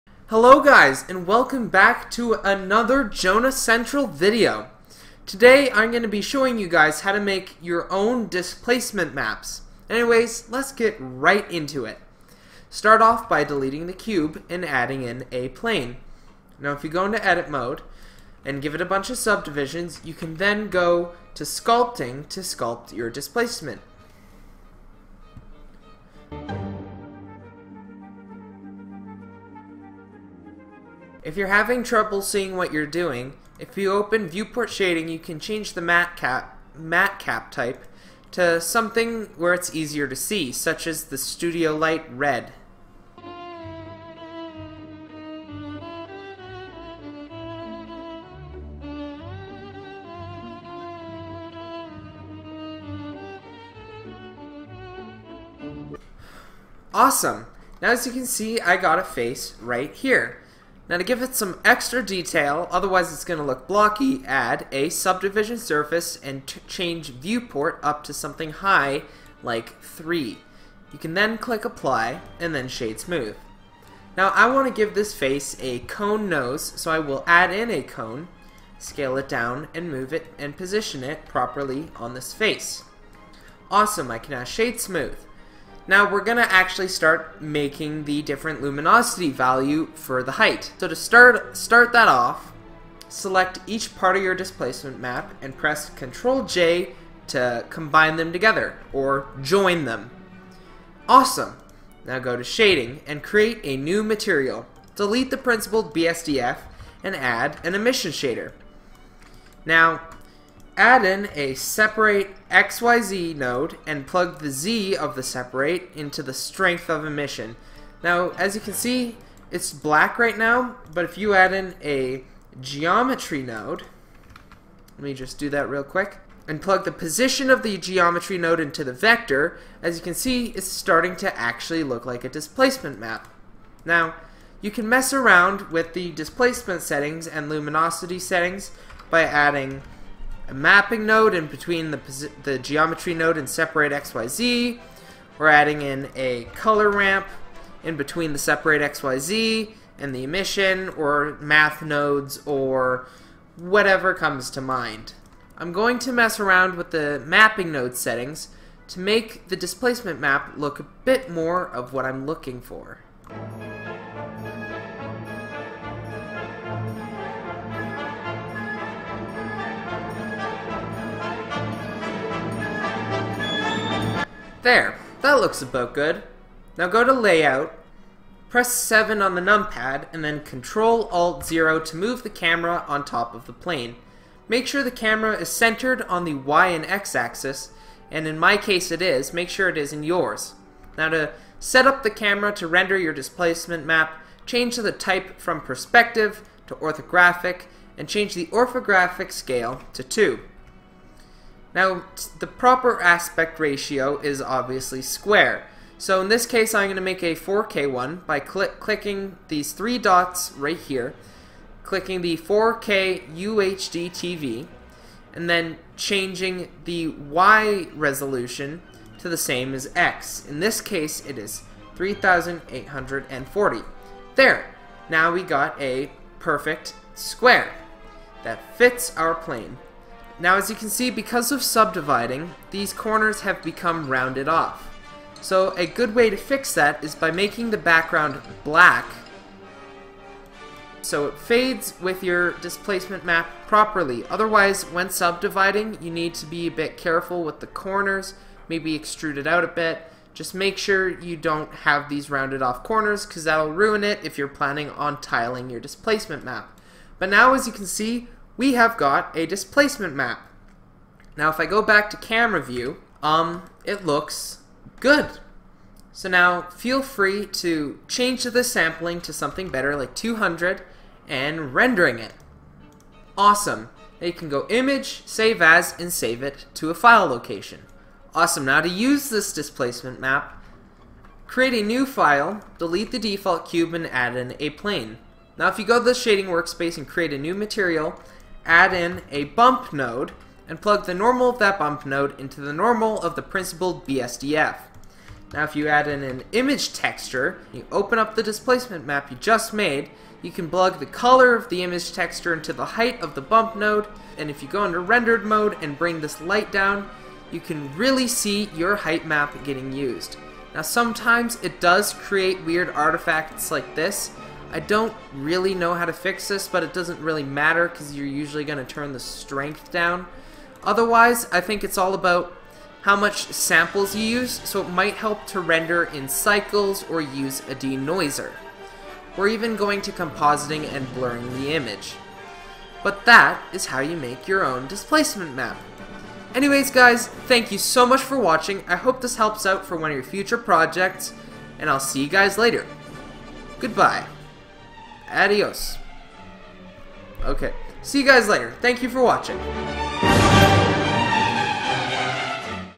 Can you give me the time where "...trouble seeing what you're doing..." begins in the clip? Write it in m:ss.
0:31.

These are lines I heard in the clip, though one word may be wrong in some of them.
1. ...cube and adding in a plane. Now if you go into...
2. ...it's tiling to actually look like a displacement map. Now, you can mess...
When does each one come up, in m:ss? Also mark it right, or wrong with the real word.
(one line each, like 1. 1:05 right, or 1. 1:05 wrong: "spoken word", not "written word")
1. 0:13 right
2. 2:10 wrong: "starting", not "tiling".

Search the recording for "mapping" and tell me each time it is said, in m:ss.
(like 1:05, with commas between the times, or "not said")
2:20, 2:37.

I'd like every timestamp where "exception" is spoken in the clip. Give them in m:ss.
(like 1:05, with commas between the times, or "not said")
not said.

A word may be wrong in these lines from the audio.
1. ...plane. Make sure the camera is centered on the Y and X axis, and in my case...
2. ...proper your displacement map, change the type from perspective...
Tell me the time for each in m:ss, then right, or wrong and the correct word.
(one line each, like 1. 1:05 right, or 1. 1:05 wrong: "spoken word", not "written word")
1. 3:03 right
2. 3:12 wrong: "render", not "proper".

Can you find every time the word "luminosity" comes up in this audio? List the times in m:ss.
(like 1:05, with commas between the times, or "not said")
1:28, 2:17.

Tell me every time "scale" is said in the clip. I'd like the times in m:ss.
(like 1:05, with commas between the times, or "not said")
1:18, 3:19.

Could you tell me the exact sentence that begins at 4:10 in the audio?
Just make sure you don't have these rounded off corners because that'll ruin it if you're planning on tiling your displacement map.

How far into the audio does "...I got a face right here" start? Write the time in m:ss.
0:58.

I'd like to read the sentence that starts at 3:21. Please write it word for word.
Now, the proper aspect ratio is obviously square.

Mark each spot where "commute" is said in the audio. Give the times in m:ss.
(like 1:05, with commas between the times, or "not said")
not said.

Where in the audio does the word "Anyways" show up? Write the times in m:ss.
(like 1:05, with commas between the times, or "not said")
0:09, 5:36.